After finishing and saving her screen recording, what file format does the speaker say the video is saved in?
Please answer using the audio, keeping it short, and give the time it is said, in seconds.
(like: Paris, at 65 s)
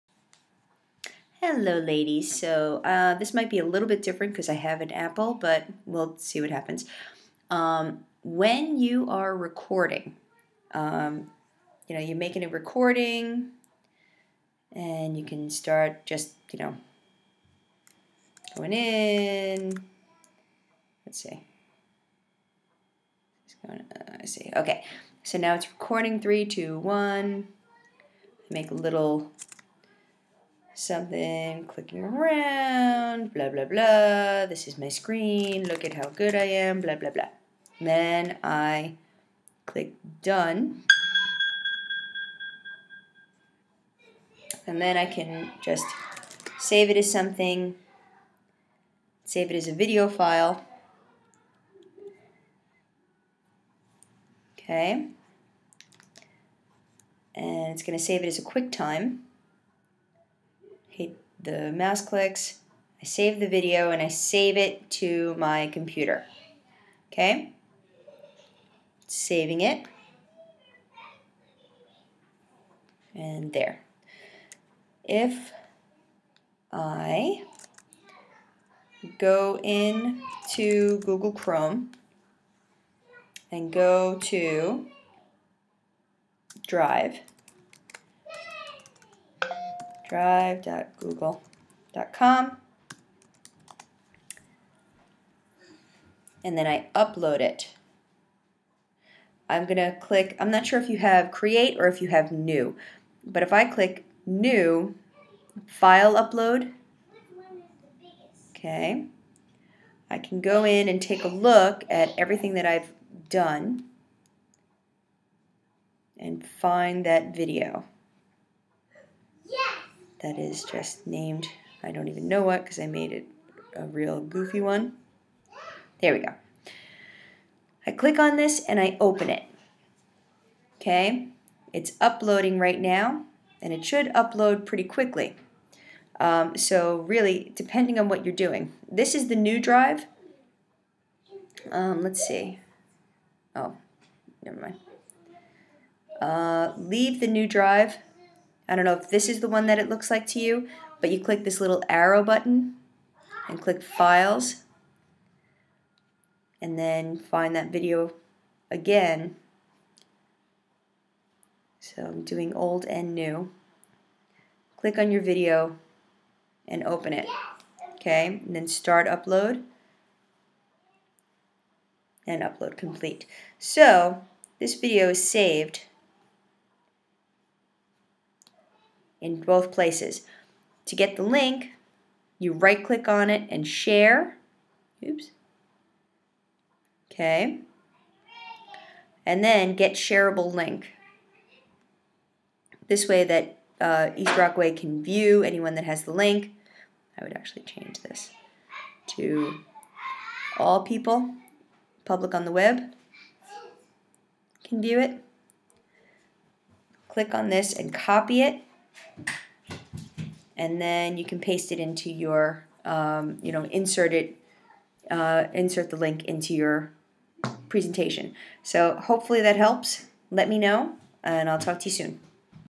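QuickTime, at 58 s.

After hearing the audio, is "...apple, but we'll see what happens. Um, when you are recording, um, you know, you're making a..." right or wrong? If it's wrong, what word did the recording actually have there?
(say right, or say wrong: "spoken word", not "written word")
right.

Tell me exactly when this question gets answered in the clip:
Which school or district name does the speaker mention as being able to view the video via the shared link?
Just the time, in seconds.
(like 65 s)
194 s.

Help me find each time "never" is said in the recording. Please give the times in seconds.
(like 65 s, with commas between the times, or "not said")
144 s.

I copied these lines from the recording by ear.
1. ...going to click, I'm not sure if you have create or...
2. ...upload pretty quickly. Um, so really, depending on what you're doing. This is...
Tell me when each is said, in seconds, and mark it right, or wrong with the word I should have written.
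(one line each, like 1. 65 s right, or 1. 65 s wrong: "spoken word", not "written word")
1. 99 s right
2. 134 s right.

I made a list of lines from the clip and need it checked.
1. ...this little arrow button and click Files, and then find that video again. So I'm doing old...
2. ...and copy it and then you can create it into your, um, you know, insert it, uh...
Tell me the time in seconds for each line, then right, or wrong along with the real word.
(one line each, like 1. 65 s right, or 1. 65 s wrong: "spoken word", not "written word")
1. 151 s right
2. 207 s wrong: "paste", not "create".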